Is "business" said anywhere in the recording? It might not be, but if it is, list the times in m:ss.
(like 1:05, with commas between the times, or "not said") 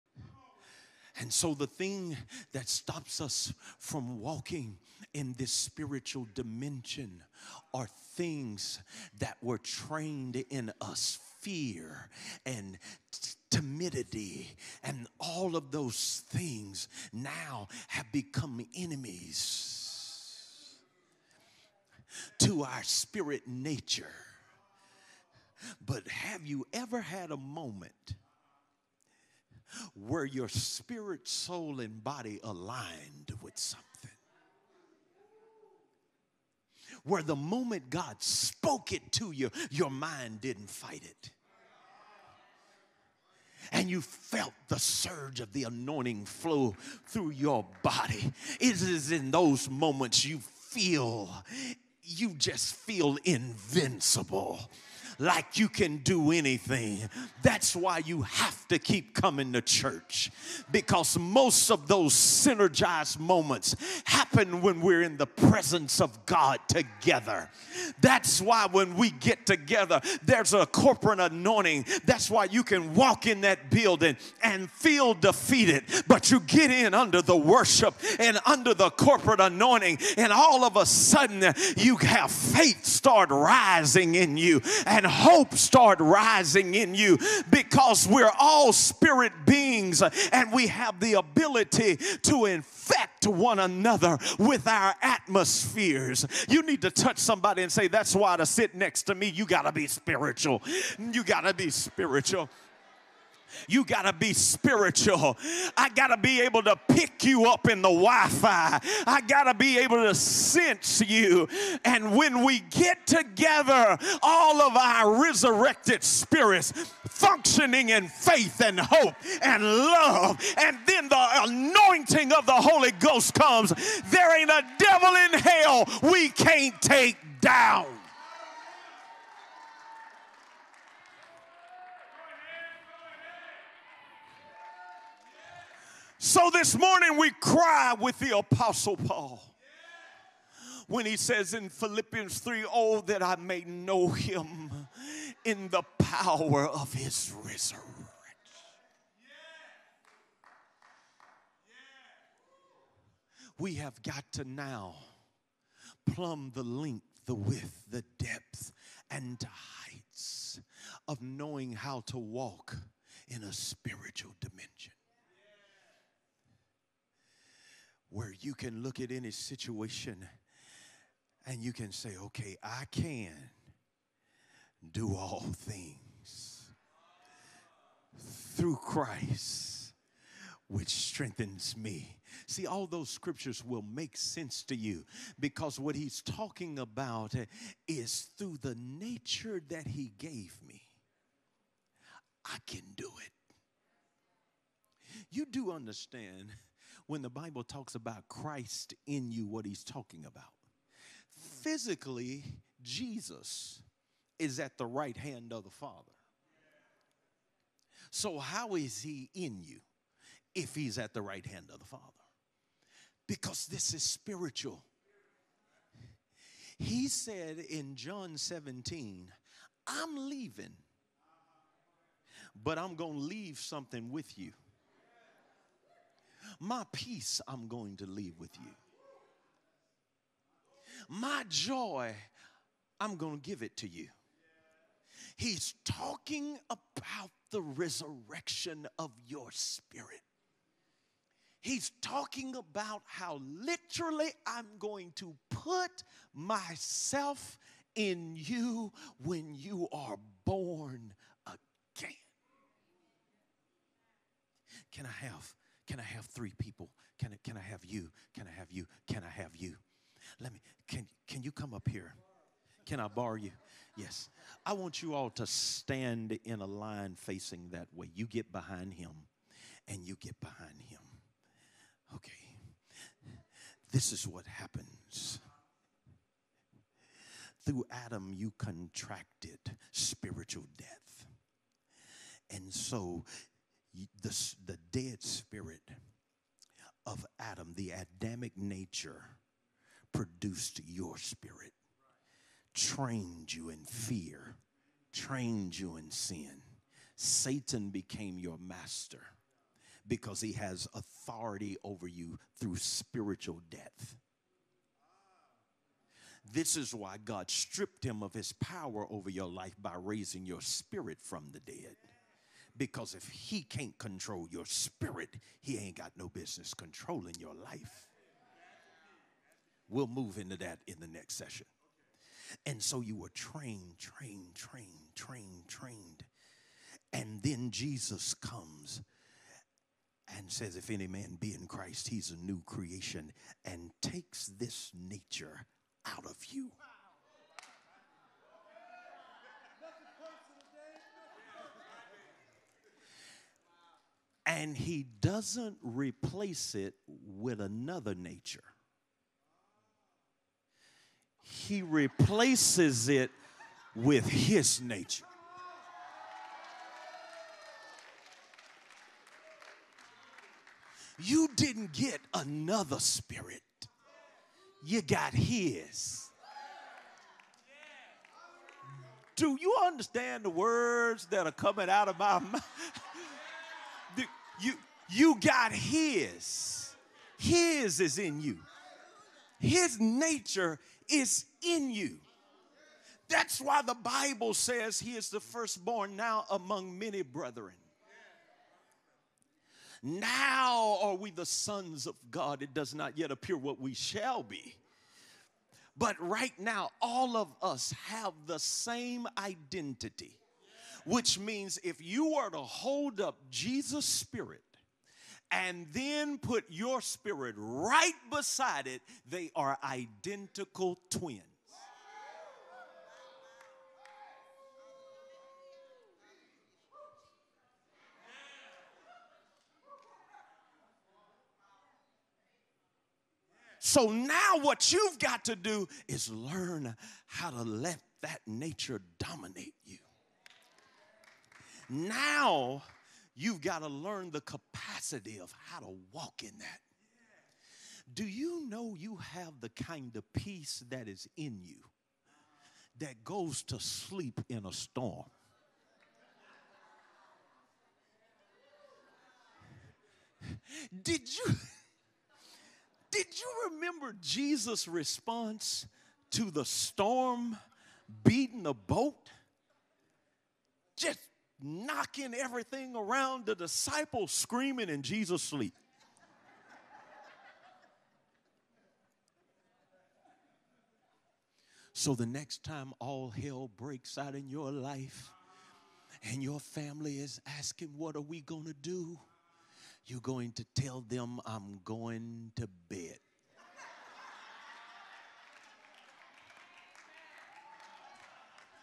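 5:16.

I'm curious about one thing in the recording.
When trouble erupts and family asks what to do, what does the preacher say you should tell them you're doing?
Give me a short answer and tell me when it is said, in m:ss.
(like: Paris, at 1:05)
going to bed, at 8:01.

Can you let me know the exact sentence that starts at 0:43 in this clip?
And you felt the surge of the anointing flow through your body.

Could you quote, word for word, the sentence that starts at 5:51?
He replaces it with his nature.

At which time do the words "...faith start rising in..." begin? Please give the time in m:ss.
1:22.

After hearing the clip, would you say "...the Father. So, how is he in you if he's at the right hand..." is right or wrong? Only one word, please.
right.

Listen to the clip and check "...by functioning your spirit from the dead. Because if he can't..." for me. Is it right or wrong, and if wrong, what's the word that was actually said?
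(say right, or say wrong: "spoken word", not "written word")
wrong: "raising", not "functioning".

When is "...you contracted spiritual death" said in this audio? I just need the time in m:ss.
4:38.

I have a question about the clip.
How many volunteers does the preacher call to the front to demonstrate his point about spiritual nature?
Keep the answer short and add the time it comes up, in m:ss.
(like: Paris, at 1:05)
3, at 4:16.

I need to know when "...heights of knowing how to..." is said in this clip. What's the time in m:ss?
2:39.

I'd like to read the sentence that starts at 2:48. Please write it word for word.
where you can look at any situation and you can say, okay, I can do all things through Christ, which strengthens me.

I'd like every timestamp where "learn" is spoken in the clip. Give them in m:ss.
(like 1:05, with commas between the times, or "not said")
7:06, 7:13.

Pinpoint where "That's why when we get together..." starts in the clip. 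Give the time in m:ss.
1:08.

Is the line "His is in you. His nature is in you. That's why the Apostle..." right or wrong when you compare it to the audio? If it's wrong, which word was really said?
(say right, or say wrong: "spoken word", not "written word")
wrong: "Bible", not "Apostle".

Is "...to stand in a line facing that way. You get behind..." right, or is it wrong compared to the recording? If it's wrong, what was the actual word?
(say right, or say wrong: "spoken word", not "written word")
right.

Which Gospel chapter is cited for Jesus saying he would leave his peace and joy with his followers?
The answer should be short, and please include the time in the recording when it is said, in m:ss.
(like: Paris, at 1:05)
John 17, at 3:37.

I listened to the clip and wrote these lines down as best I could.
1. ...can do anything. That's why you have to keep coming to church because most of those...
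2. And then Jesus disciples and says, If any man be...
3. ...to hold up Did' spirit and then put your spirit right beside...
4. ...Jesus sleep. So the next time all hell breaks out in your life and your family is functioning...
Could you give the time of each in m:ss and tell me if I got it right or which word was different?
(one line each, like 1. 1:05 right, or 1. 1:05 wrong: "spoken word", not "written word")
1. 0:55 right
2. 5:27 wrong: "comes", not "disciples"
3. 6:42 wrong: "Jesus", not "Did"
4. 7:45 wrong: "asking", not "functioning".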